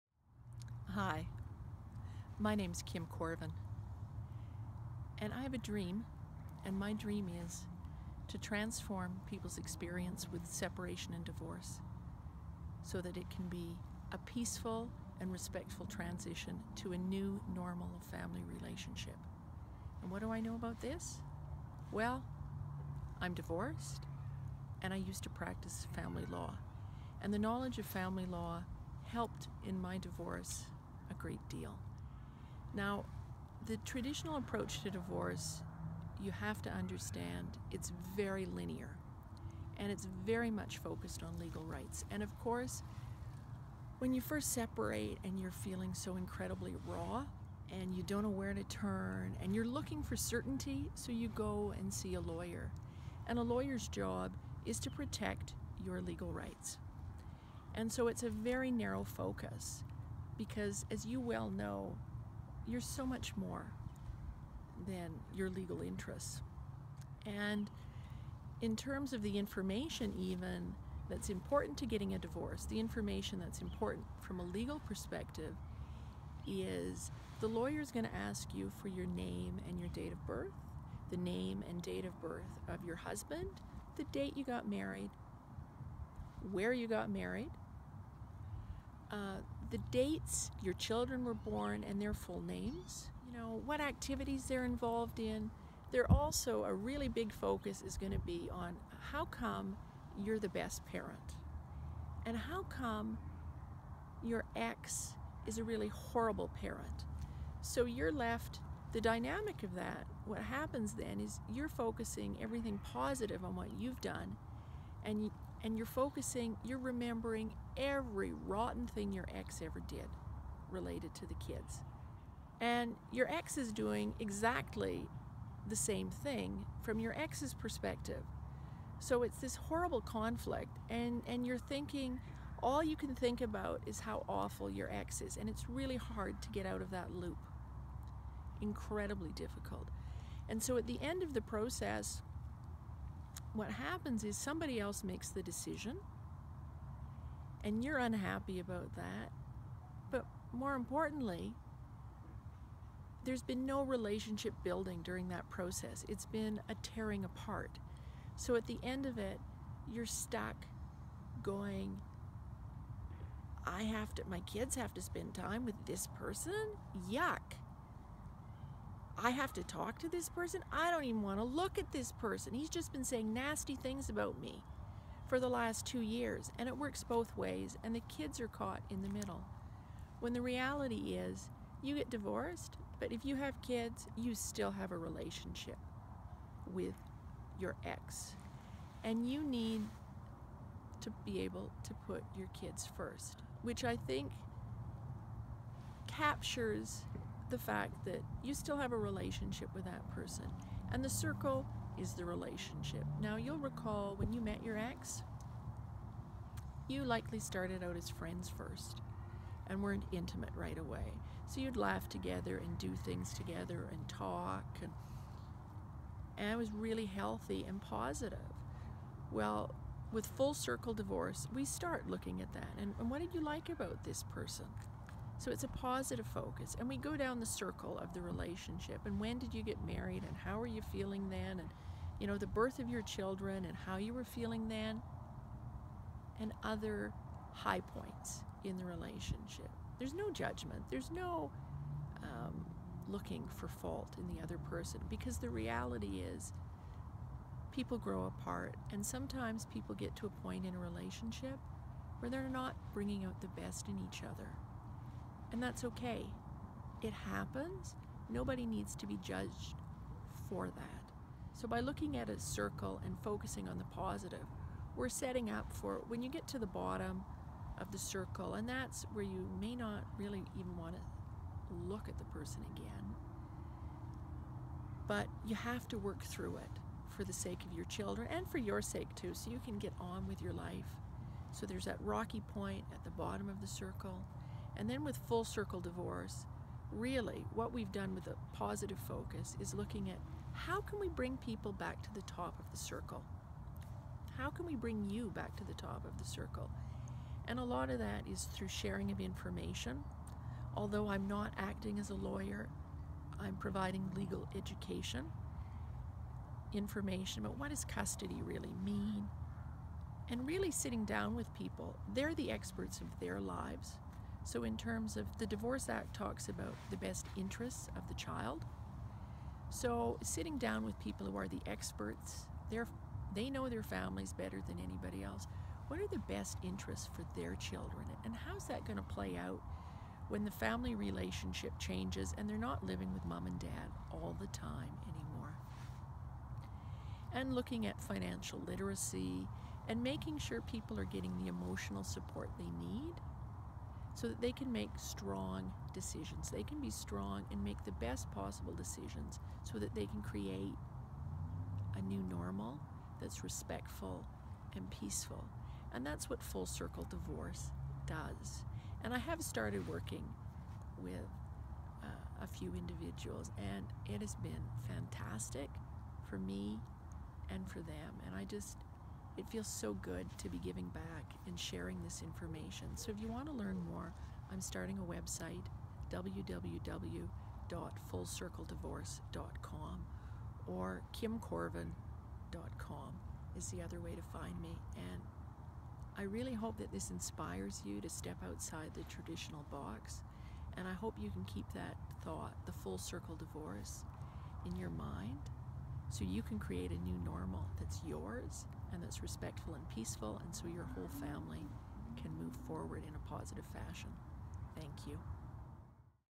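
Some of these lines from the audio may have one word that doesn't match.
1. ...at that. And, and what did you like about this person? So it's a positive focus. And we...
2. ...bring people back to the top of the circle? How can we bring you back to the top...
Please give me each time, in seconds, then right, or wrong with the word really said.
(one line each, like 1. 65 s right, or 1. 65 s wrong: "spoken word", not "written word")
1. 222 s right
2. 291 s right.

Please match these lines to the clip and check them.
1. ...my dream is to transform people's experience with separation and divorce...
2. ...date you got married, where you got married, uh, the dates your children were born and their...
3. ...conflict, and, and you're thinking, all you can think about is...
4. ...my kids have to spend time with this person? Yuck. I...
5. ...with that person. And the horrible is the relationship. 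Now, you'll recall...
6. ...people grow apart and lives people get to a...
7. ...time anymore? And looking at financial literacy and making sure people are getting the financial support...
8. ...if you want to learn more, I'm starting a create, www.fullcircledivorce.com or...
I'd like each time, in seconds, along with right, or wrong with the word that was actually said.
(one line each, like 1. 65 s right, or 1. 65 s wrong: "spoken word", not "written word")
1. 6 s right
2. 84 s right
3. 130 s right
4. 164 s right
5. 199 s wrong: "circle", not "horrible"
6. 247 s wrong: "sometimes", not "lives"
7. 334 s wrong: "emotional", not "financial"
8. 373 s wrong: "website", not "create".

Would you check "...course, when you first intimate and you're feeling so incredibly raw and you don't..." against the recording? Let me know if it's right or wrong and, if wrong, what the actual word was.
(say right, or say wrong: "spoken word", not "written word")
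wrong: "separate", not "intimate".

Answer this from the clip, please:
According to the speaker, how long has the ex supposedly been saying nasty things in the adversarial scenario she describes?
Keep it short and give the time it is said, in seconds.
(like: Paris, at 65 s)
2 years, at 175 s.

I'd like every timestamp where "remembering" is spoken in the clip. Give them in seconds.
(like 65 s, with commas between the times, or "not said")
116 s.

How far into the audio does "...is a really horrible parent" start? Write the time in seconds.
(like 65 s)
105 s.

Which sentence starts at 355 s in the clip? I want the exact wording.
And that's what full circle divorce does.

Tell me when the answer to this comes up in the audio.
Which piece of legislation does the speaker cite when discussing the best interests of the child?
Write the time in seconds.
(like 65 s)
315 s.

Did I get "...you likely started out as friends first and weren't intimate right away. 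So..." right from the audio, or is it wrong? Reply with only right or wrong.
right.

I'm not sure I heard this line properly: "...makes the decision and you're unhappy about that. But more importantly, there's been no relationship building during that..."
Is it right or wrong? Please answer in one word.
right.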